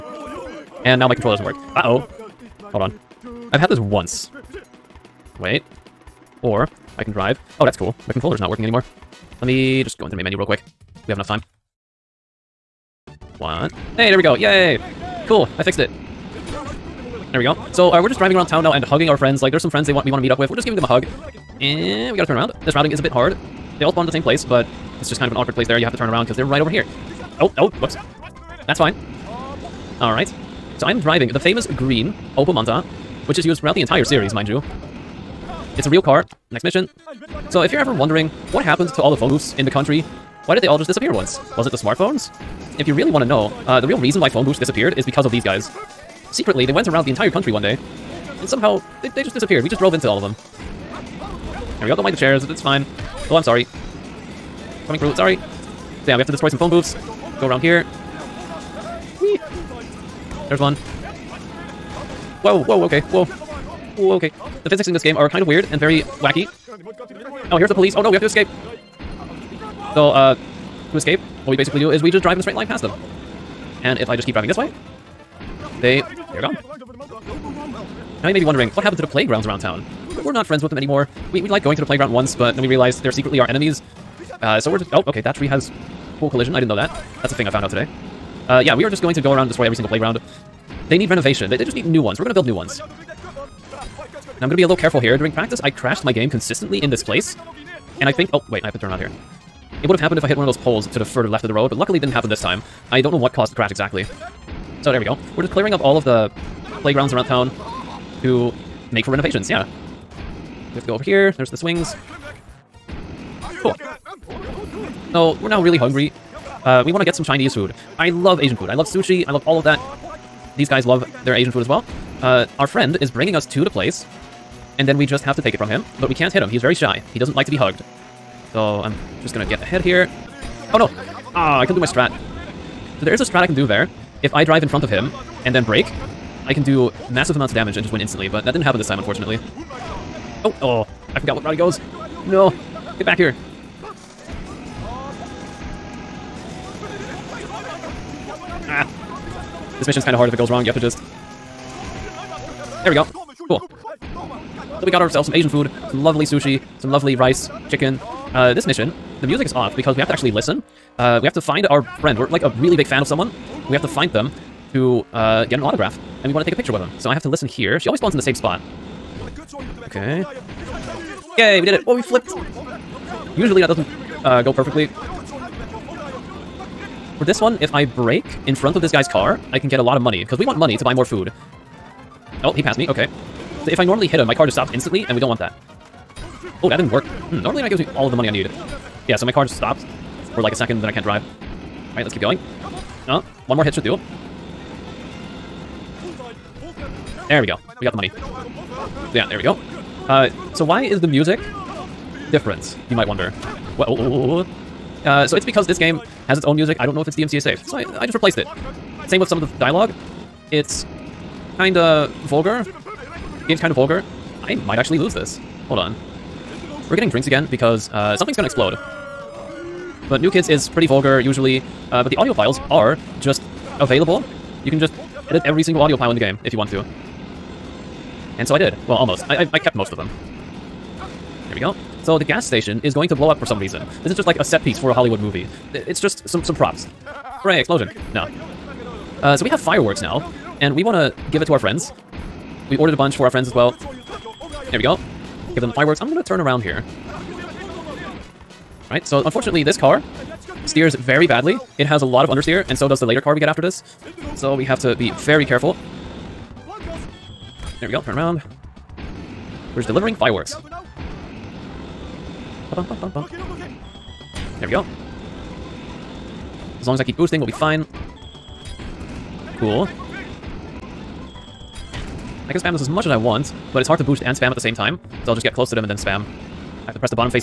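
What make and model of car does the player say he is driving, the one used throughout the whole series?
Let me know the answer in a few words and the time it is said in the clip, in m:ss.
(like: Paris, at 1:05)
Opel Manta, at 0:32.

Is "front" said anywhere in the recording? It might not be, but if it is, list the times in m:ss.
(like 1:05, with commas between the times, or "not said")
2:14, 2:58.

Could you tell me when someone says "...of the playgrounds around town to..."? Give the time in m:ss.
1:45.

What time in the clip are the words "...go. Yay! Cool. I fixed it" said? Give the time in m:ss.
0:14.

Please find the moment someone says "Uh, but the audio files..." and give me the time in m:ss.
3:41.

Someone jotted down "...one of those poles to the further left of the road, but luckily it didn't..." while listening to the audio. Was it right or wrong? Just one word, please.
right.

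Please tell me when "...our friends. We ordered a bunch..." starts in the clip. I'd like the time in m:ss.
4:01.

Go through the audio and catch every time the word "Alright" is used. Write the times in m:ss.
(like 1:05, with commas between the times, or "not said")
0:30, 3:11.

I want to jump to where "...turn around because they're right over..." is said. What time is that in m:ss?
0:25.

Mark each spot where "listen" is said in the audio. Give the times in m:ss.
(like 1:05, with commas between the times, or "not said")
2:40, 2:47.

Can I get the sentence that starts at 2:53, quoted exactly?
Usually that doesn't uh, go perfectly.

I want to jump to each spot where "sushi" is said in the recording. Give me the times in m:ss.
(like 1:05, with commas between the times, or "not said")
1:58, 2:36.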